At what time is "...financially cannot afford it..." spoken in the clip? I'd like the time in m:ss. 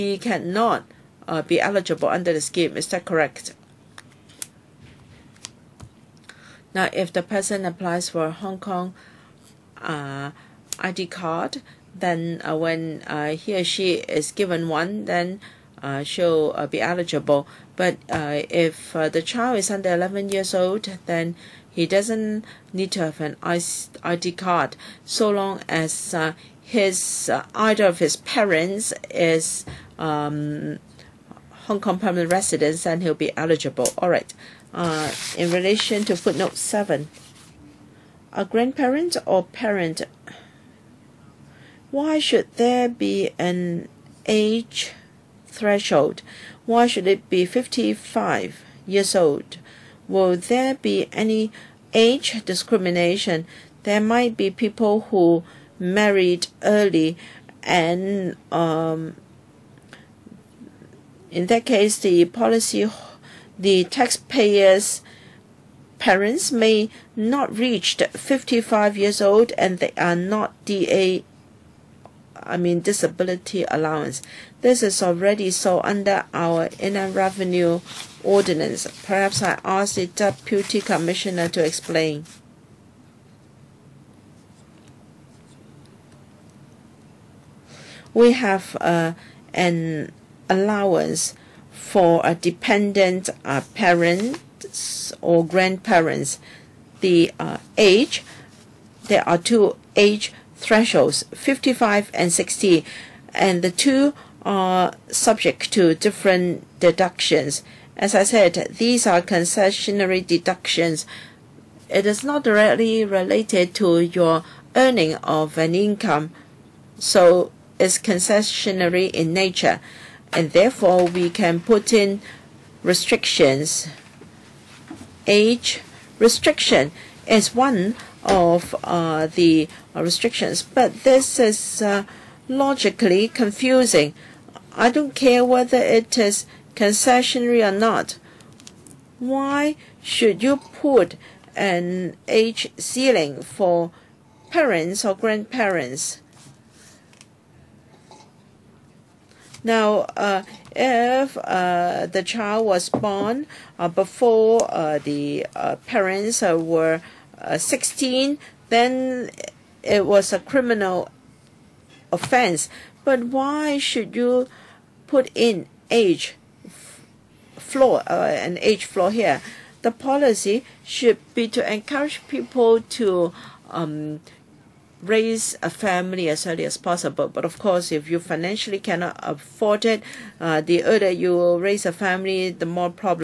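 2:58.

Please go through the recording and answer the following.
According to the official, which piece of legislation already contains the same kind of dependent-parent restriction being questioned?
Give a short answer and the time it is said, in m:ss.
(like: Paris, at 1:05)
Inland Revenue Ordinance, at 1:16.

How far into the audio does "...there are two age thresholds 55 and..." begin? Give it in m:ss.
1:39.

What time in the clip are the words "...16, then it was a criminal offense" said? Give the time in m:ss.
2:37.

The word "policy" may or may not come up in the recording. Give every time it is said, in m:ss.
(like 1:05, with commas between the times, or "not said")
1:02, 2:49.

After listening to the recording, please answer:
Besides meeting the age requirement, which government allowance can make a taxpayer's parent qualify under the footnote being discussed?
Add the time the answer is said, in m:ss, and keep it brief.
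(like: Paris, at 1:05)
Disability allowance, at 1:12.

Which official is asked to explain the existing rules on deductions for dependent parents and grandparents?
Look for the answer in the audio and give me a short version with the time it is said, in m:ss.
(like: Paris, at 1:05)
Deputy commissioner, at 1:20.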